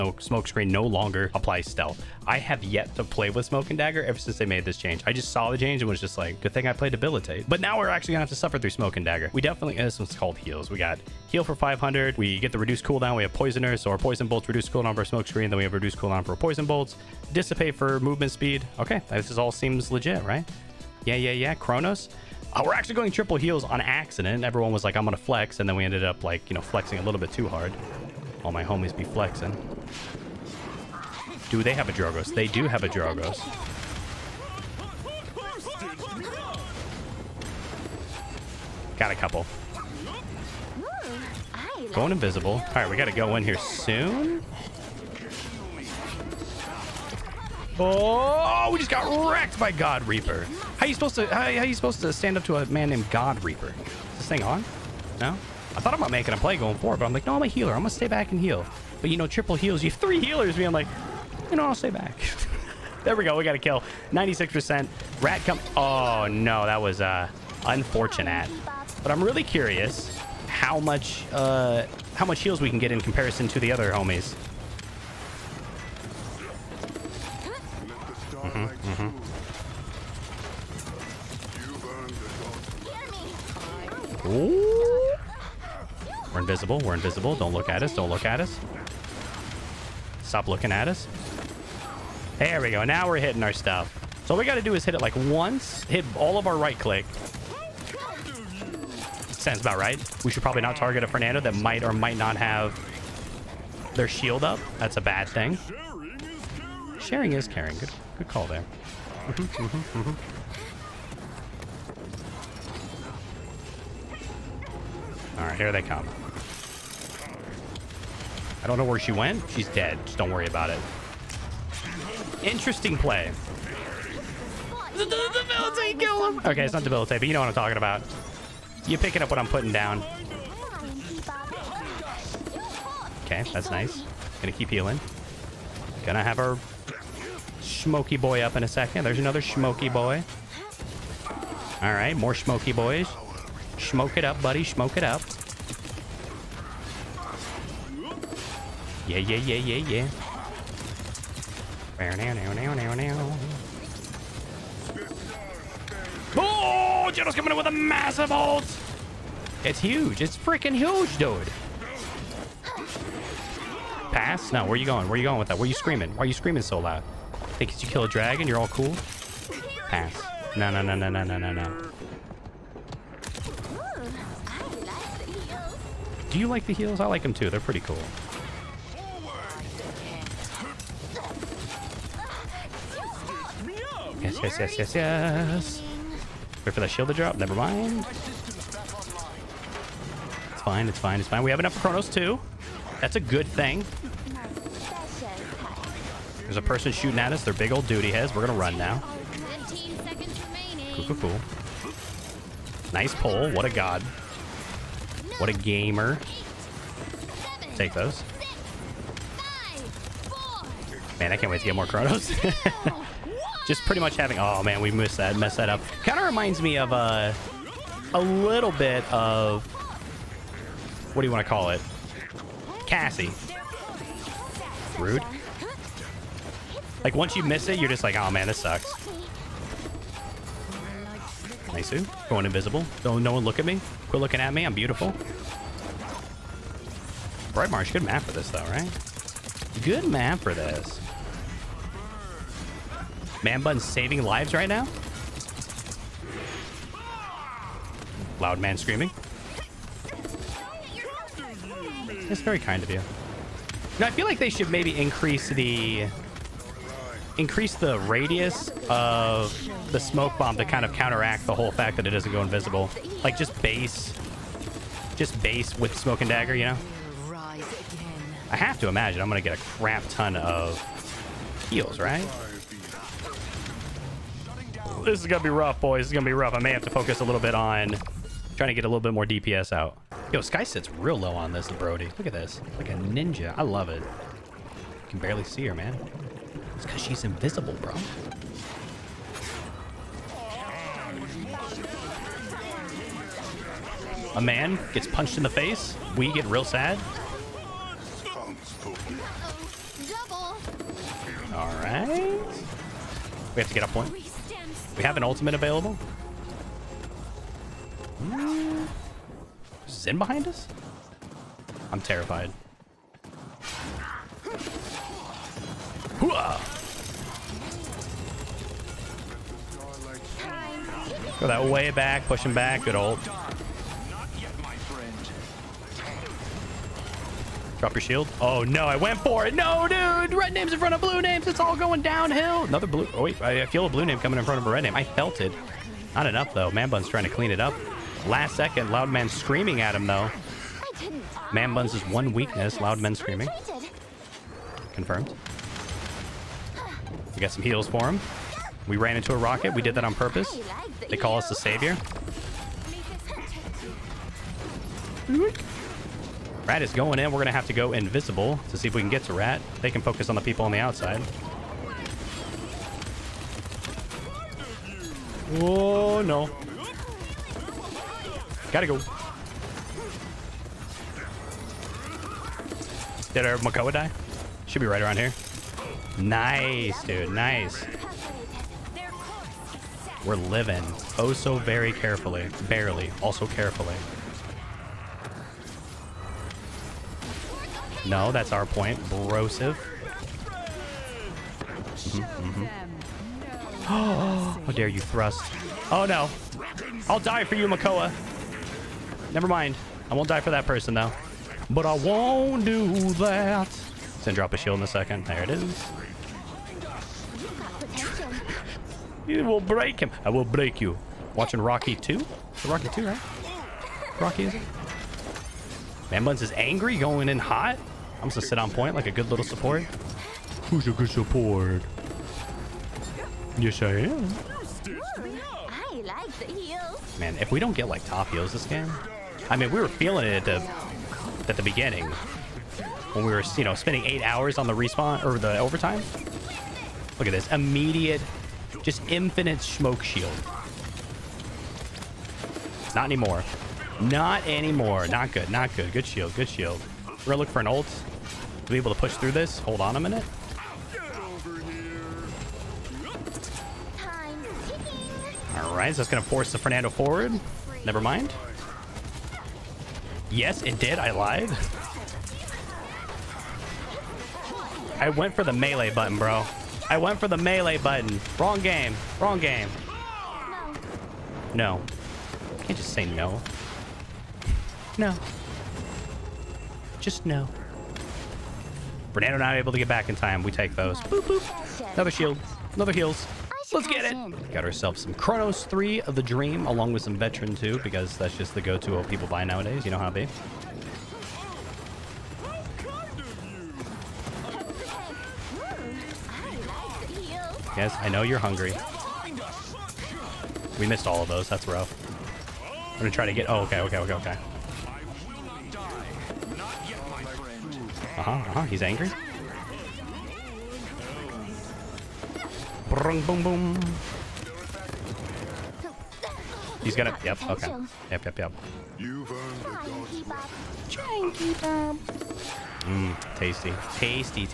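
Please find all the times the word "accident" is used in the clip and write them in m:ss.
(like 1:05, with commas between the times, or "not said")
0:23.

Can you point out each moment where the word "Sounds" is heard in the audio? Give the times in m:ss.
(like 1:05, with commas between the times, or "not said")
1:39.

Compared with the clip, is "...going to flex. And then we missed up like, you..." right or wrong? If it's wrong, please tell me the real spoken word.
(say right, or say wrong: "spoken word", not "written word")
wrong: "ended", not "missed".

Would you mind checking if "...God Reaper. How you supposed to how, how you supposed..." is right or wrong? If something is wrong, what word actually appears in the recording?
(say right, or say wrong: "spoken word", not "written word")
right.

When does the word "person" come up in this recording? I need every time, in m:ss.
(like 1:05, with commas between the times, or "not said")
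3:16, 6:40.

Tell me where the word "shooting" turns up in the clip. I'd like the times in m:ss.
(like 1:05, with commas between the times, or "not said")
3:16.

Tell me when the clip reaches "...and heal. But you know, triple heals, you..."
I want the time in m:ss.
0:58.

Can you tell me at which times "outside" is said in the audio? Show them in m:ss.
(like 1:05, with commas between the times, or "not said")
6:00.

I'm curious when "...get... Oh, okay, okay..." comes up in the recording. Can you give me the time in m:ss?
8:23.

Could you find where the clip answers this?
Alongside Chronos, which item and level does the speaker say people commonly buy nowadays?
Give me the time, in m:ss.
8:07.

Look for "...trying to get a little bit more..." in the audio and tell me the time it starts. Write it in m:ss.
4:38.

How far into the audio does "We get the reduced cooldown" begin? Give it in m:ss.
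0:12.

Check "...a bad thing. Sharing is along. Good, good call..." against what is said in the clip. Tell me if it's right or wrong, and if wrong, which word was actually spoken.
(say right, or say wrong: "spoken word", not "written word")
wrong: "caring", not "along".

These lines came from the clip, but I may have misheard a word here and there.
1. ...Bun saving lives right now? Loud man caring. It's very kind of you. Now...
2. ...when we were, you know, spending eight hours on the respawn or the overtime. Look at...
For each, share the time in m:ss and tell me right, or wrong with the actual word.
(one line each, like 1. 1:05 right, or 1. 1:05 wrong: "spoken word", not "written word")
1. 4:03 wrong: "screaming", not "caring"
2. 7:13 right.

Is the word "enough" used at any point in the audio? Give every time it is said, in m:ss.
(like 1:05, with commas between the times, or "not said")
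3:11, 5:36.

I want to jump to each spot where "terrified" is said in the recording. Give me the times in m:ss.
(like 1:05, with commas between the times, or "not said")
5:12.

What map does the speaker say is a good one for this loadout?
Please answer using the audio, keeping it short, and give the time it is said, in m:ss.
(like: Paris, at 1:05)
Bright Marsh, at 3:57.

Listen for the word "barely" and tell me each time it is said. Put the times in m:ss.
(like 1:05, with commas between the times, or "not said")
4:45, 6:22.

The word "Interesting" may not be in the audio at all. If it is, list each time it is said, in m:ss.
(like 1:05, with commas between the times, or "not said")
2:02.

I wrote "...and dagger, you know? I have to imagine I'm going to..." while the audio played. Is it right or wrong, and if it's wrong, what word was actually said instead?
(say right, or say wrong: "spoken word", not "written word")
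right.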